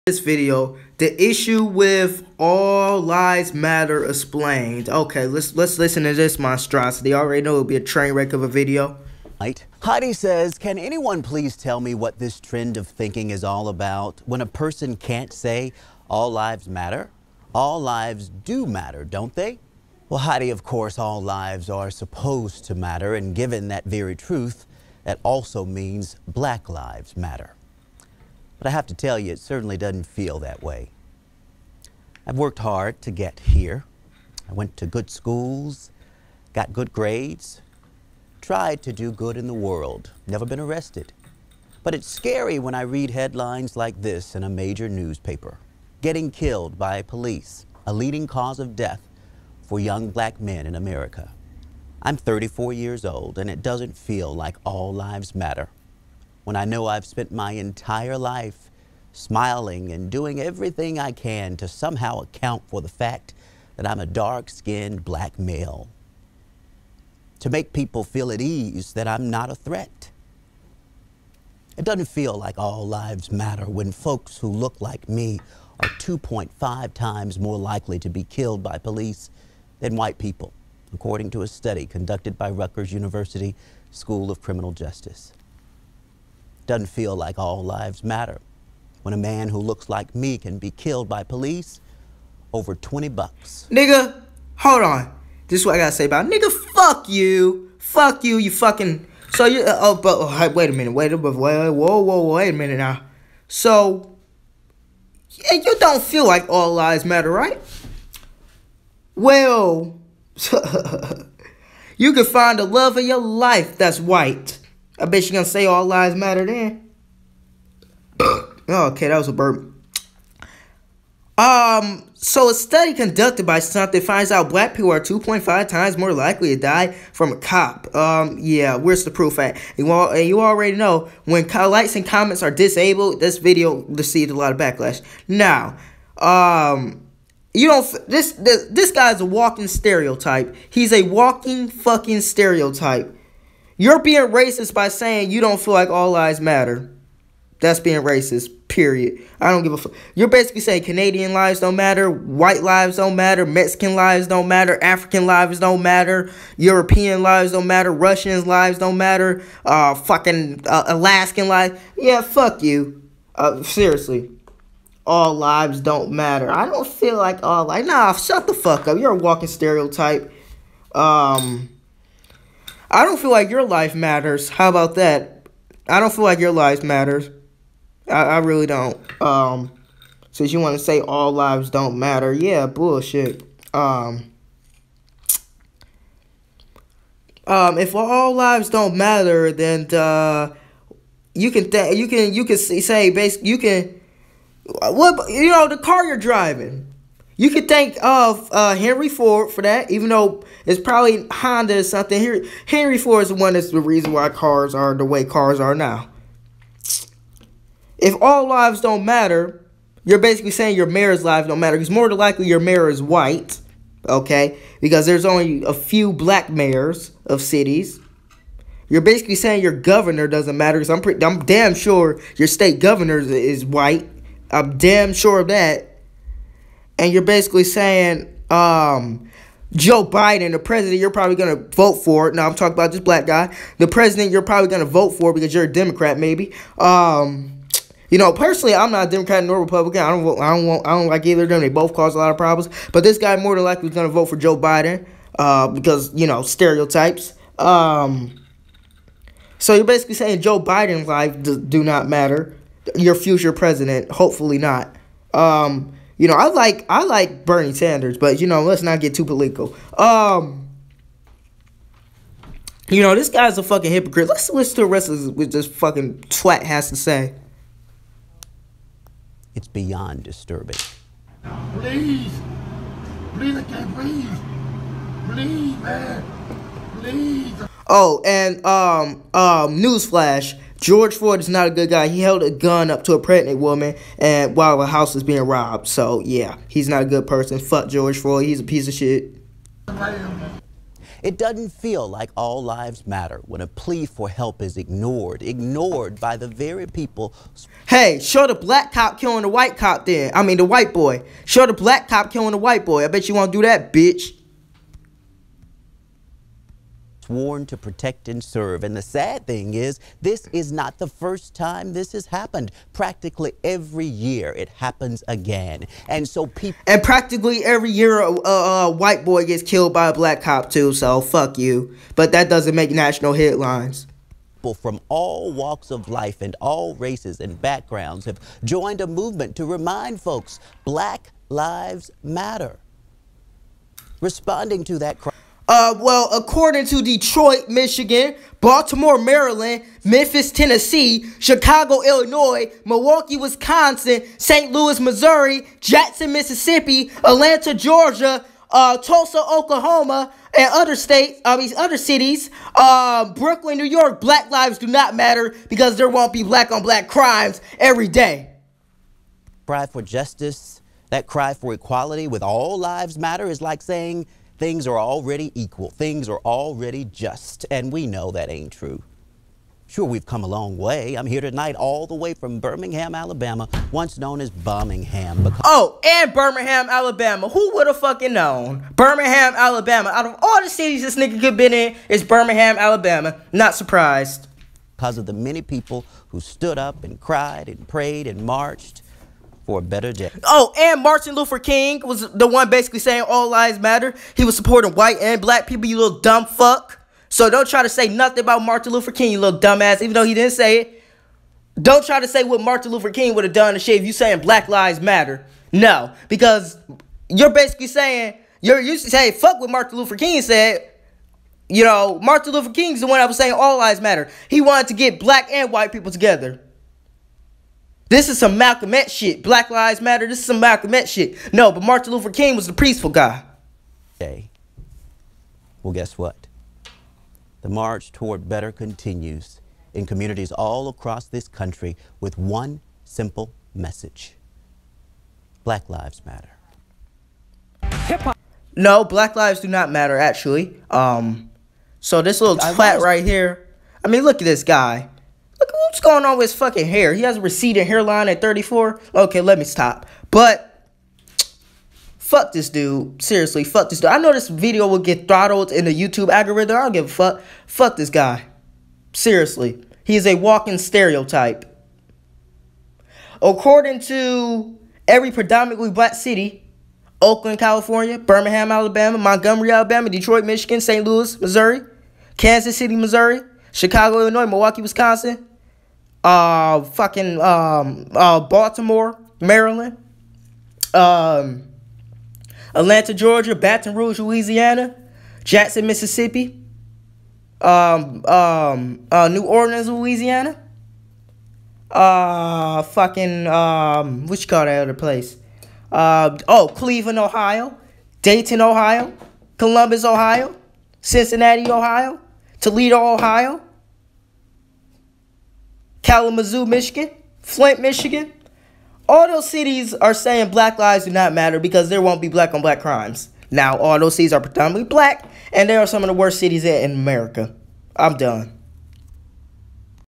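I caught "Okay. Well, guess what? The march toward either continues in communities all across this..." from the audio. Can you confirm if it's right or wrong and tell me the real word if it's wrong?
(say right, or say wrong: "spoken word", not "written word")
wrong: "better", not "either".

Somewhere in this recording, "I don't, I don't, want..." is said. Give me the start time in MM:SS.
04:00.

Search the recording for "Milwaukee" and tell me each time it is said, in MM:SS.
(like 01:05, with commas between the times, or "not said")
05:42, 07:54.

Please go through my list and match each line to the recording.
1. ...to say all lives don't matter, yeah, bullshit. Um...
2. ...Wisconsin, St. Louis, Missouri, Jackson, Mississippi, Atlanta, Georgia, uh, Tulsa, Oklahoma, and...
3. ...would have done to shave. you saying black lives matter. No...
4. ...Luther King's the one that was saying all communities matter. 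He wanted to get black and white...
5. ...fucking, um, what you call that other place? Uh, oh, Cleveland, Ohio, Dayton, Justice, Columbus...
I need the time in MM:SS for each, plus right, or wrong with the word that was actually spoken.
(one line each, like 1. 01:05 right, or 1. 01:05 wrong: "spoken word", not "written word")
1. 03:00 right
2. 05:43 right
3. 06:43 right
4. 06:52 wrong: "lives", not "communities"
5. 08:12 wrong: "Ohio", not "Justice".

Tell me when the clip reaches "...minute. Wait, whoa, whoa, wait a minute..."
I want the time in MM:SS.
01:41.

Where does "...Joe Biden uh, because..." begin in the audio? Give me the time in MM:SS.
04:04.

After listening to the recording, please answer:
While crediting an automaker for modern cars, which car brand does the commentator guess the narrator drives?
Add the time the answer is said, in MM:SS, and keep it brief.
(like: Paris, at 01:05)
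Honda, at 03:21.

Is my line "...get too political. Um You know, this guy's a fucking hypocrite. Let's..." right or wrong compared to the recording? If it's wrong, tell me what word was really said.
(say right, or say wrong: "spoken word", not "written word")
right.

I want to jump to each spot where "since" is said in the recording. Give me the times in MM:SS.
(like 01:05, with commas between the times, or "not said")
03:00.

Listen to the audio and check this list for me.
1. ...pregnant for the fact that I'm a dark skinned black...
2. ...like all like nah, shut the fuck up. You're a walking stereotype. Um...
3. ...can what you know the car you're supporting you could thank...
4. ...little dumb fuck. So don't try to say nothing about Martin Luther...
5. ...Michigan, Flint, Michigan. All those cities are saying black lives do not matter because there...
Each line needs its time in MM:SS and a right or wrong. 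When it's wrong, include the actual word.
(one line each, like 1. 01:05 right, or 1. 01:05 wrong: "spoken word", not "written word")
1. 01:02 wrong: "account", not "pregnant"
2. 02:47 right
3. 03:13 wrong: "driving", not "supporting"
4. 06:35 right
5. 08:26 right.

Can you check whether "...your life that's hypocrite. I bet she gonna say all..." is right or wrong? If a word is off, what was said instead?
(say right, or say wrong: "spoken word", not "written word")
wrong: "white", not "hypocrite".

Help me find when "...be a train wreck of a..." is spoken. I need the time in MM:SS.
00:07.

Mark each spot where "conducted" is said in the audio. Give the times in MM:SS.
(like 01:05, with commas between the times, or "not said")
01:21, 02:02.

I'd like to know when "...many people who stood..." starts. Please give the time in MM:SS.
06:25.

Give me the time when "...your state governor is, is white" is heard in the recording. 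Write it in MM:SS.
03:42.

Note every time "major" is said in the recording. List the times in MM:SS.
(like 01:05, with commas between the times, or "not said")
00:44.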